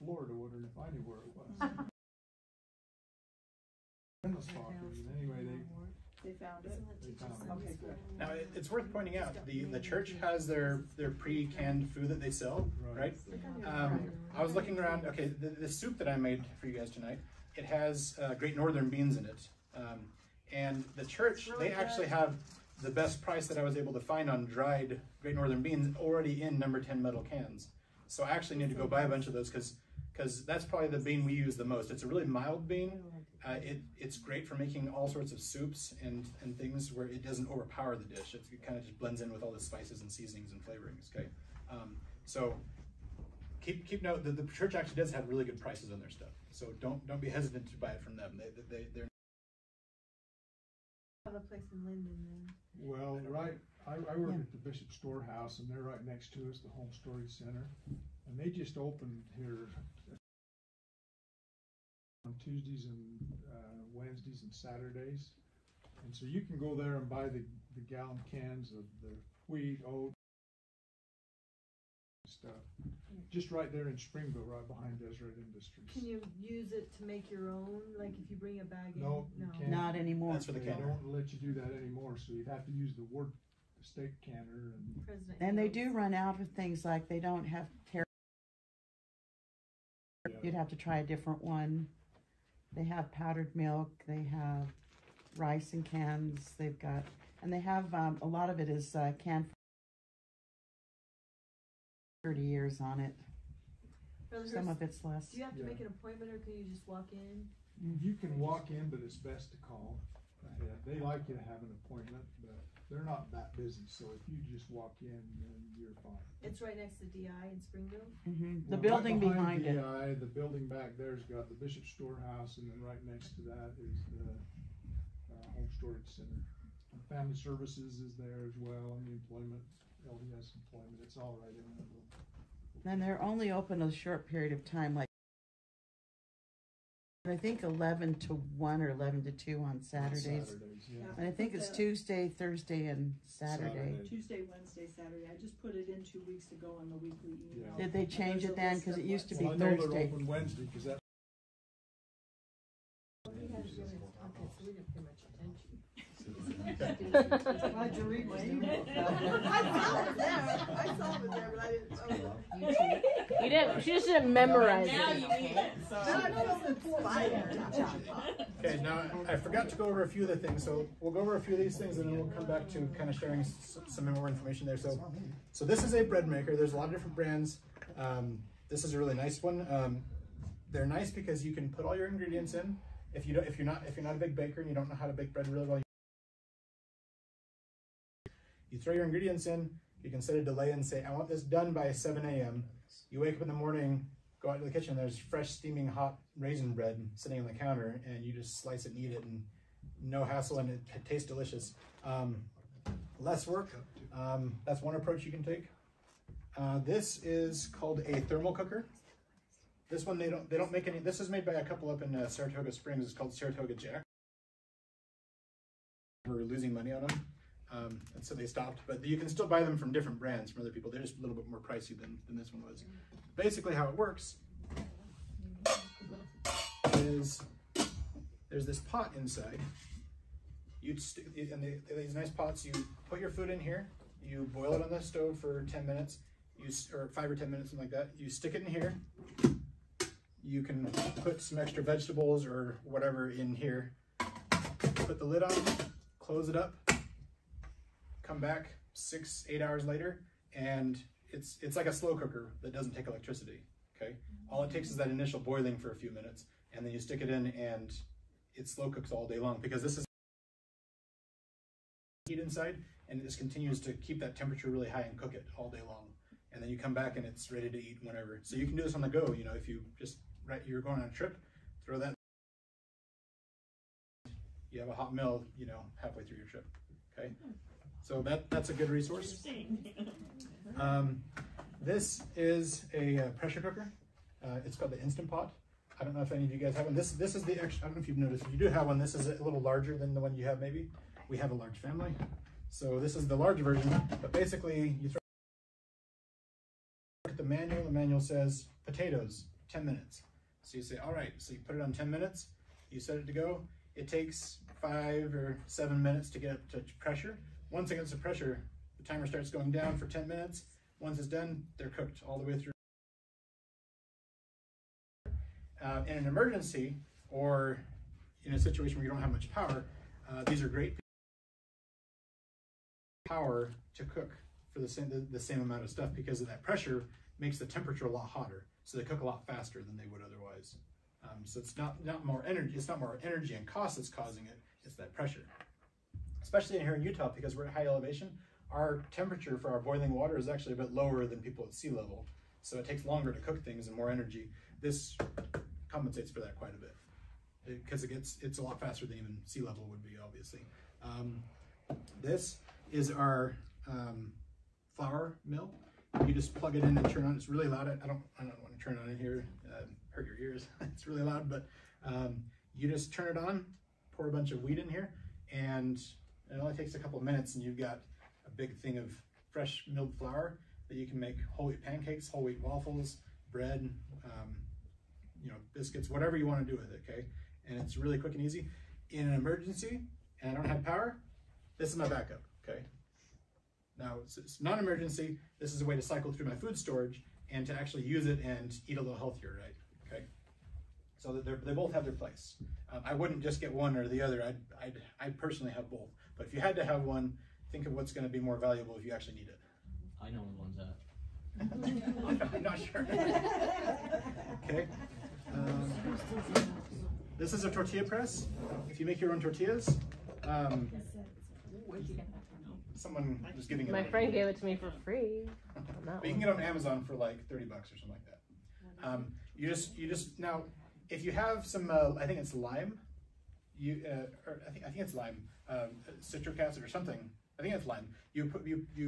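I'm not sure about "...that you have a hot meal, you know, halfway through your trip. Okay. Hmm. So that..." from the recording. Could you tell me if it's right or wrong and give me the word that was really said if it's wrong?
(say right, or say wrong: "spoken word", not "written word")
right.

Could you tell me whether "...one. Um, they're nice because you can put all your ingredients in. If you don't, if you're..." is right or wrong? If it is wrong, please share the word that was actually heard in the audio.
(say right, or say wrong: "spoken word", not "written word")
right.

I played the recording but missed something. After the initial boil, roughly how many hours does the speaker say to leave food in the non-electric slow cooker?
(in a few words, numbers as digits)
6 to 8 hours.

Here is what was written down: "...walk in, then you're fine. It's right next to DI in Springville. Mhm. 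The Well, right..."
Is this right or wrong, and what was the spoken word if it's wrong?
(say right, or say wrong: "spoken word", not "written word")
right.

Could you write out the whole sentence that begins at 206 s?
Uh, this is called a thermal cooker.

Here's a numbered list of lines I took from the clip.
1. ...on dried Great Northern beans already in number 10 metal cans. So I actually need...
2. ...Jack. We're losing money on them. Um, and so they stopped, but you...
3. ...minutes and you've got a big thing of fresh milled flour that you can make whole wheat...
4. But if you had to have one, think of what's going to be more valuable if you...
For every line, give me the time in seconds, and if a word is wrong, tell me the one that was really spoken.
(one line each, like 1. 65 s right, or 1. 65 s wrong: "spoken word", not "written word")
1. 24 s right
2. 213 s right
3. 367 s right
4. 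396 s right.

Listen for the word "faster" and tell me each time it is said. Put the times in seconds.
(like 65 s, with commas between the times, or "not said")
329 s, 348 s.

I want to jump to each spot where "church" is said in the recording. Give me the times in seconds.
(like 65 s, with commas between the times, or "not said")
9 s, 21 s, 44 s.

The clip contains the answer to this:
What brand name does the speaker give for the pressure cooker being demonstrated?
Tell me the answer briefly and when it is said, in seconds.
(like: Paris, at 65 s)
Instant Pot, at 285 s.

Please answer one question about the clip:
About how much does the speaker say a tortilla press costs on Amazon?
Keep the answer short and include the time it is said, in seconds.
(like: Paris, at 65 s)
$30, at 417 s.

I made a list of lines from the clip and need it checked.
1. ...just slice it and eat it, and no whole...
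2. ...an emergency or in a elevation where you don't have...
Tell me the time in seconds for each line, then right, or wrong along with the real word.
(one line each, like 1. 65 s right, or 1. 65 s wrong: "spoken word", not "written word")
1. 198 s wrong: "hassle", not "whole"
2. 316 s wrong: "situation", not "elevation".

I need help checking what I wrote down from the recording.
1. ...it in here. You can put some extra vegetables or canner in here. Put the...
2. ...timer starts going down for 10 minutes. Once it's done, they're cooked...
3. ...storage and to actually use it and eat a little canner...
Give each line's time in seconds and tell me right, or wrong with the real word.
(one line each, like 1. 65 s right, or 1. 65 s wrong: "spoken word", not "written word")
1. 238 s wrong: "whatever", not "canner"
2. 309 s right
3. 386 s wrong: "healthier", not "canner".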